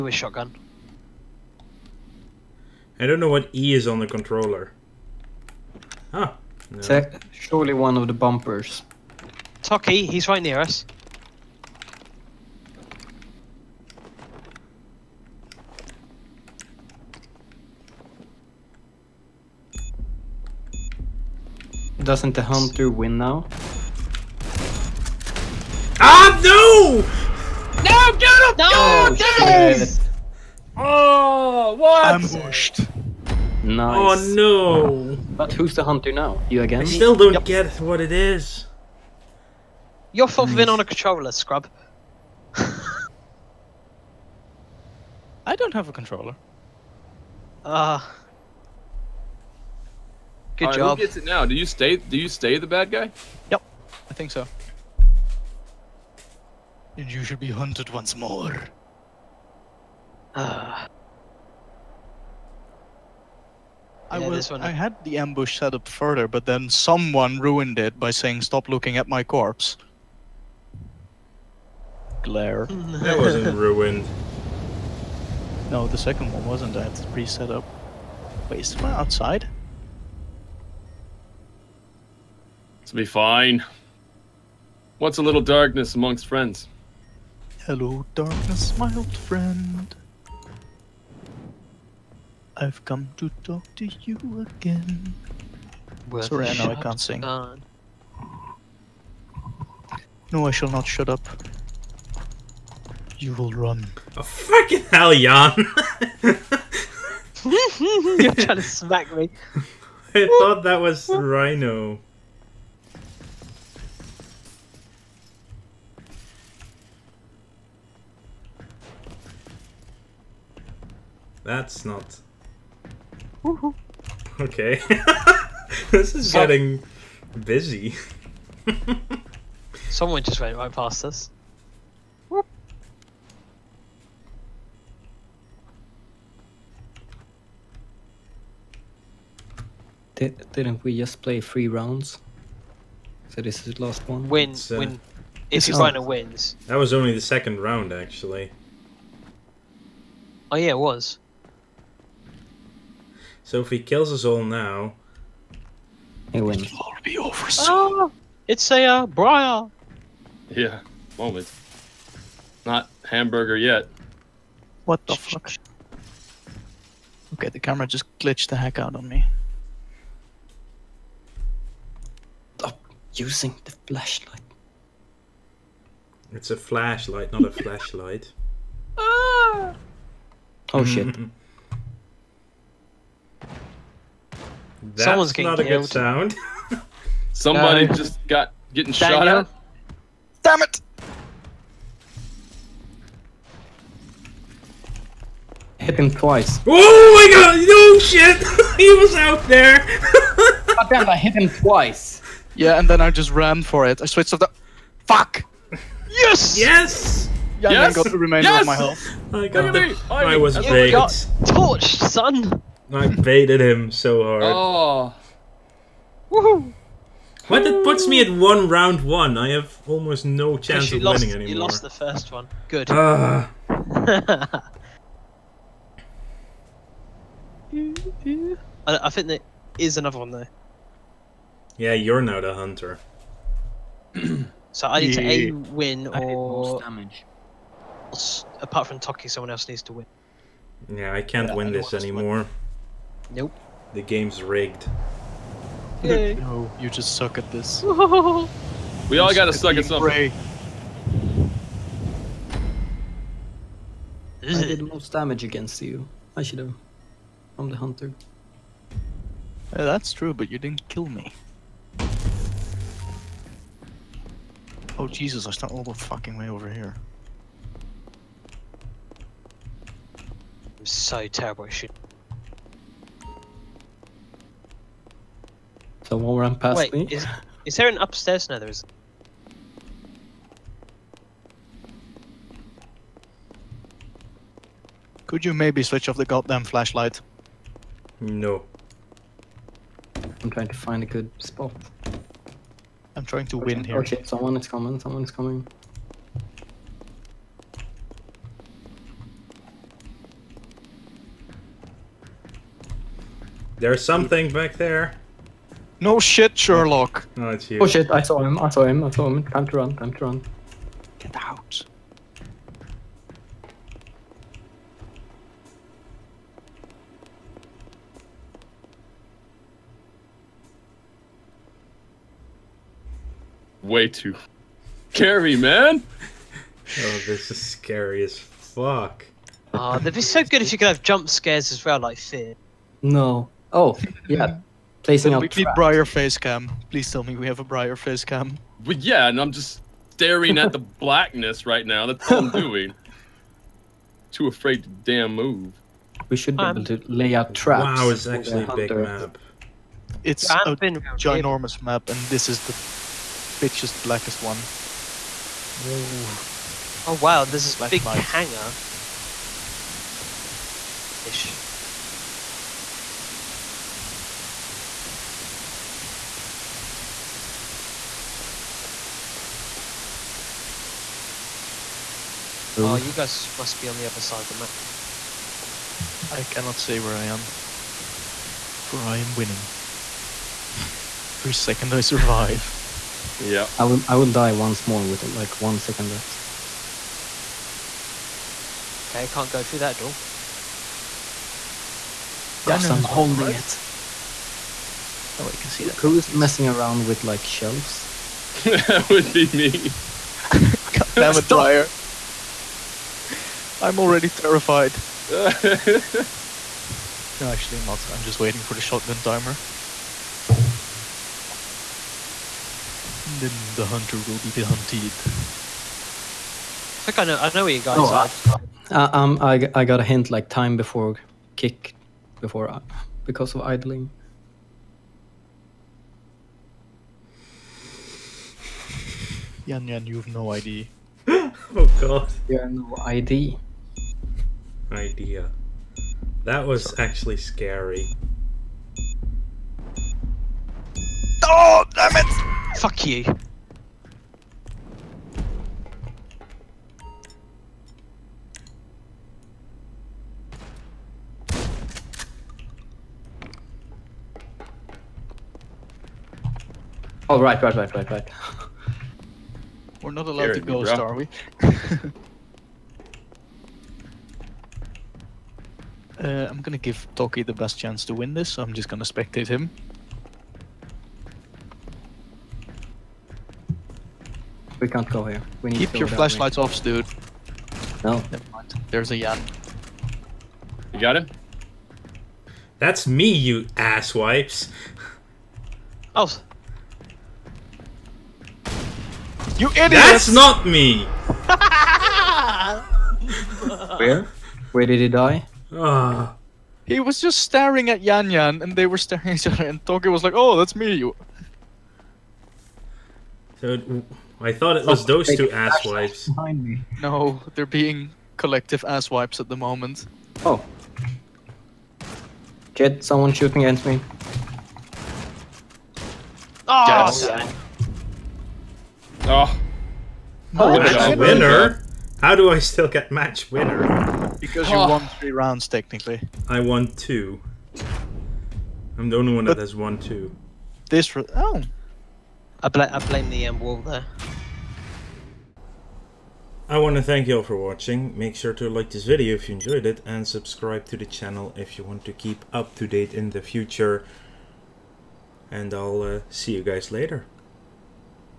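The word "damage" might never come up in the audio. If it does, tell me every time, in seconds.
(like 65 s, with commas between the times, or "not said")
236 s, 255 s.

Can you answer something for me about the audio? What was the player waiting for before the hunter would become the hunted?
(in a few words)
Shotgun timer.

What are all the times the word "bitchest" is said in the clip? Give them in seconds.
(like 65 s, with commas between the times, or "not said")
353 s.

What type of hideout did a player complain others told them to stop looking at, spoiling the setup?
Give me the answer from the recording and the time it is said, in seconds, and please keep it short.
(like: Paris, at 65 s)
Corpse lair, at 69 s.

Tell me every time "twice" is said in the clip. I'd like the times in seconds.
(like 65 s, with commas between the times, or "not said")
196 s, 201 s.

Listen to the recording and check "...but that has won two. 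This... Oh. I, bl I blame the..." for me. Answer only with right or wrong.
right.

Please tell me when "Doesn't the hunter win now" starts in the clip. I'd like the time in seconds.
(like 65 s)
22 s.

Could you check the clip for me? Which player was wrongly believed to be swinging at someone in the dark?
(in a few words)
Rhino.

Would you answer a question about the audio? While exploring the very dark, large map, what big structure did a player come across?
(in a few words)
Hangar.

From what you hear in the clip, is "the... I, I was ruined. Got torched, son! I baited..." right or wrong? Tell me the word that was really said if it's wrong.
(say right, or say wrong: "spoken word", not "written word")
wrong: "baited", not "ruined".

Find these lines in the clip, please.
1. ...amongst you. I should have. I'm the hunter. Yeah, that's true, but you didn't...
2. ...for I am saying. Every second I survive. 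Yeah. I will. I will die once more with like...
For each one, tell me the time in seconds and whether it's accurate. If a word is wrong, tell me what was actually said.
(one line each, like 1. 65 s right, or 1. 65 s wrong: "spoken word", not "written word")
1. 255 s wrong: "against", not "amongst"
2. 378 s wrong: "winning", not "saying".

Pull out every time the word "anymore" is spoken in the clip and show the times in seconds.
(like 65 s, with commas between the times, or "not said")
221 s, 241 s.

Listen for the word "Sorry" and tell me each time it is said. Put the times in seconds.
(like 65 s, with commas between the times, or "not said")
96 s, 436 s.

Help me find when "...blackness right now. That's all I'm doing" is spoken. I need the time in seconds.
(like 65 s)
340 s.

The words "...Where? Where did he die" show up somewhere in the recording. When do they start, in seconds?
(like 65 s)
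493 s.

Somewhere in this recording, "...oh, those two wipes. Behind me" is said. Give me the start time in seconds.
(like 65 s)
505 s.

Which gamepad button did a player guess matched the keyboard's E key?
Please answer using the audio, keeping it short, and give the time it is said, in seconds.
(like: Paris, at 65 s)
One of the bumpers, at 7 s.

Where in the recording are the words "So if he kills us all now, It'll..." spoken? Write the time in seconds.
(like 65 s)
153 s.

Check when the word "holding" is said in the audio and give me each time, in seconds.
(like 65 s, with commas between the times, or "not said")
393 s.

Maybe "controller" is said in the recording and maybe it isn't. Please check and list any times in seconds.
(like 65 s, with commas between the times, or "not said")
4 s, 40 s, 45 s.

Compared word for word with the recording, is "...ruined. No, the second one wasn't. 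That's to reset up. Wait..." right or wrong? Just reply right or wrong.
right.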